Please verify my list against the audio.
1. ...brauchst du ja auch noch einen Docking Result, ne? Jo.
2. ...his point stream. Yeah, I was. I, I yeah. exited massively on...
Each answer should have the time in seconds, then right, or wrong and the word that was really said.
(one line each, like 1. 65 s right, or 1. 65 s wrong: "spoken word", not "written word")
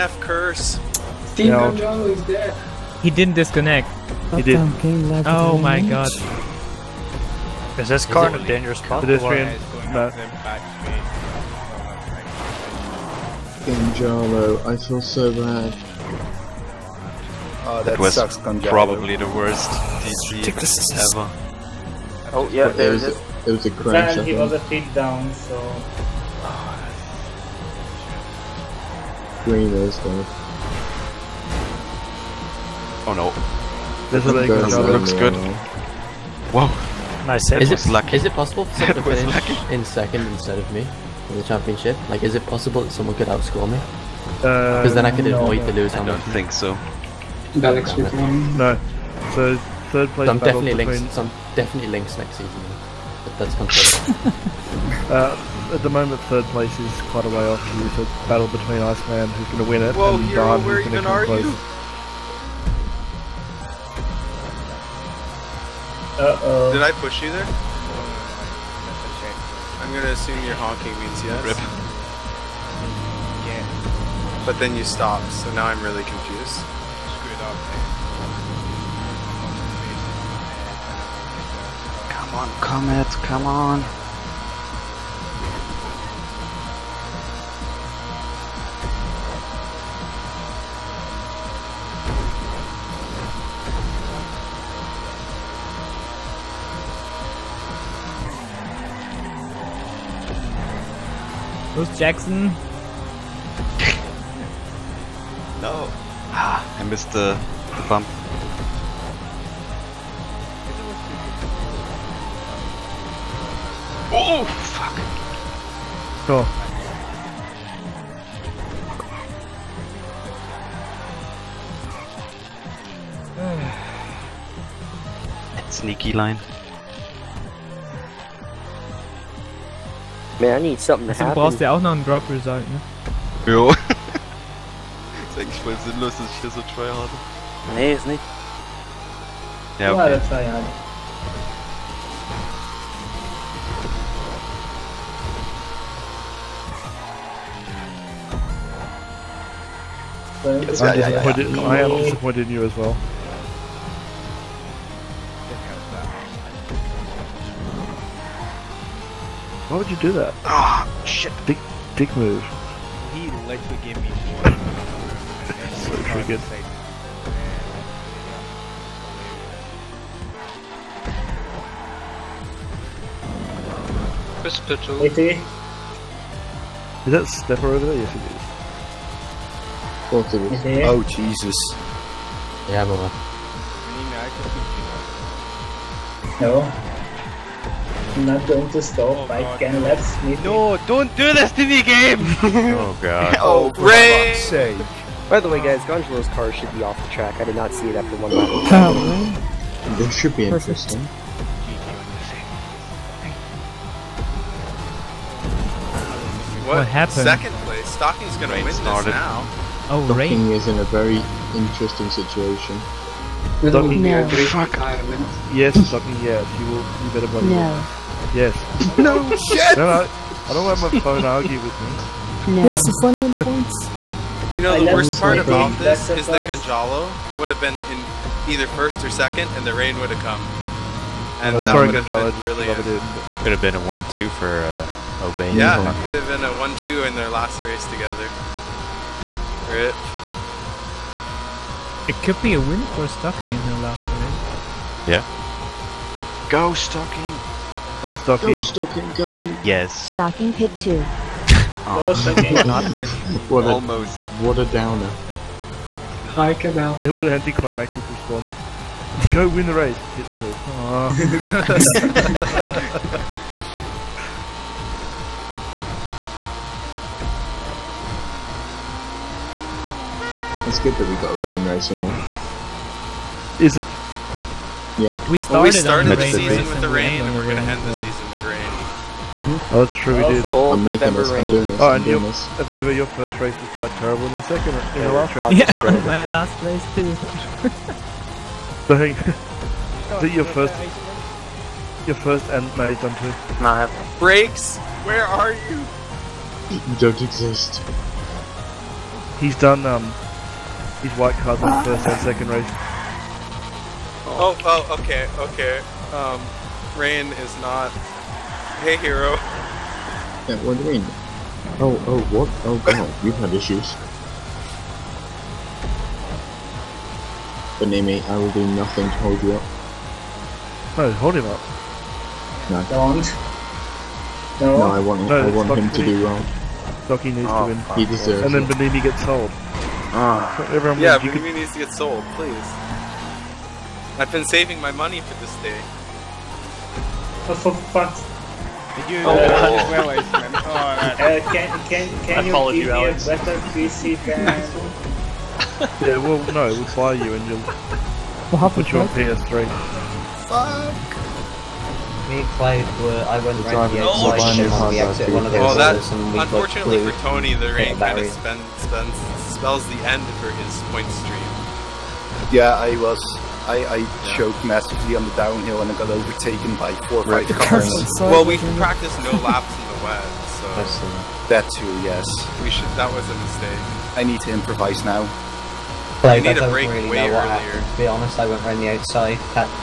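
1. 131 s wrong: "Drop", not "Docking"
2. 360 s wrong: "choked", not "exited".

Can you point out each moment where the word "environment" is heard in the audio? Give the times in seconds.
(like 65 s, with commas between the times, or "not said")
not said.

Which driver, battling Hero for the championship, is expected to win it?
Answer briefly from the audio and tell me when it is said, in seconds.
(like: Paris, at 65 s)
Iceman, at 58 s.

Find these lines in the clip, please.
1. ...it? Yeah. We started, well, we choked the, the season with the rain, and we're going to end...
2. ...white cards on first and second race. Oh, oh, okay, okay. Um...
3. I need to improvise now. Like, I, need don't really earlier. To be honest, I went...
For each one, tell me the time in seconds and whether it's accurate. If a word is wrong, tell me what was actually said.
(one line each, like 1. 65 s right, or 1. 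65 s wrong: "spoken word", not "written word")
1. 273 s wrong: "started", not "choked"
2. 301 s right
3. 374 s right.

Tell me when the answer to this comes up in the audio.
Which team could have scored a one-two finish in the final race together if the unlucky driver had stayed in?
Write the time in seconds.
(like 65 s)
235 s.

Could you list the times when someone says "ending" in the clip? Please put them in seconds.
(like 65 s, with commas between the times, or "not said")
not said.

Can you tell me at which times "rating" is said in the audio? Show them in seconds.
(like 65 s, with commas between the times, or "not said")
not said.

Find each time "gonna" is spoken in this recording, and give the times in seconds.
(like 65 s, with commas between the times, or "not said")
69 s, 208 s.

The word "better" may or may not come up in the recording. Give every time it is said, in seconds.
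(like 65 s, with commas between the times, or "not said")
217 s, 343 s.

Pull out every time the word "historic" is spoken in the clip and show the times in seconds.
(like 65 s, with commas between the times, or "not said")
not said.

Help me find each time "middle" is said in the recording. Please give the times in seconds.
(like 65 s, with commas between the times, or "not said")
not said.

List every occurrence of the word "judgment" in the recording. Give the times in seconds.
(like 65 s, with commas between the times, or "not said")
not said.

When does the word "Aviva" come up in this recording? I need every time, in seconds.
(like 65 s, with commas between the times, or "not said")
282 s.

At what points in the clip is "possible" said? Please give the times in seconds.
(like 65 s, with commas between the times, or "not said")
38 s, 42 s.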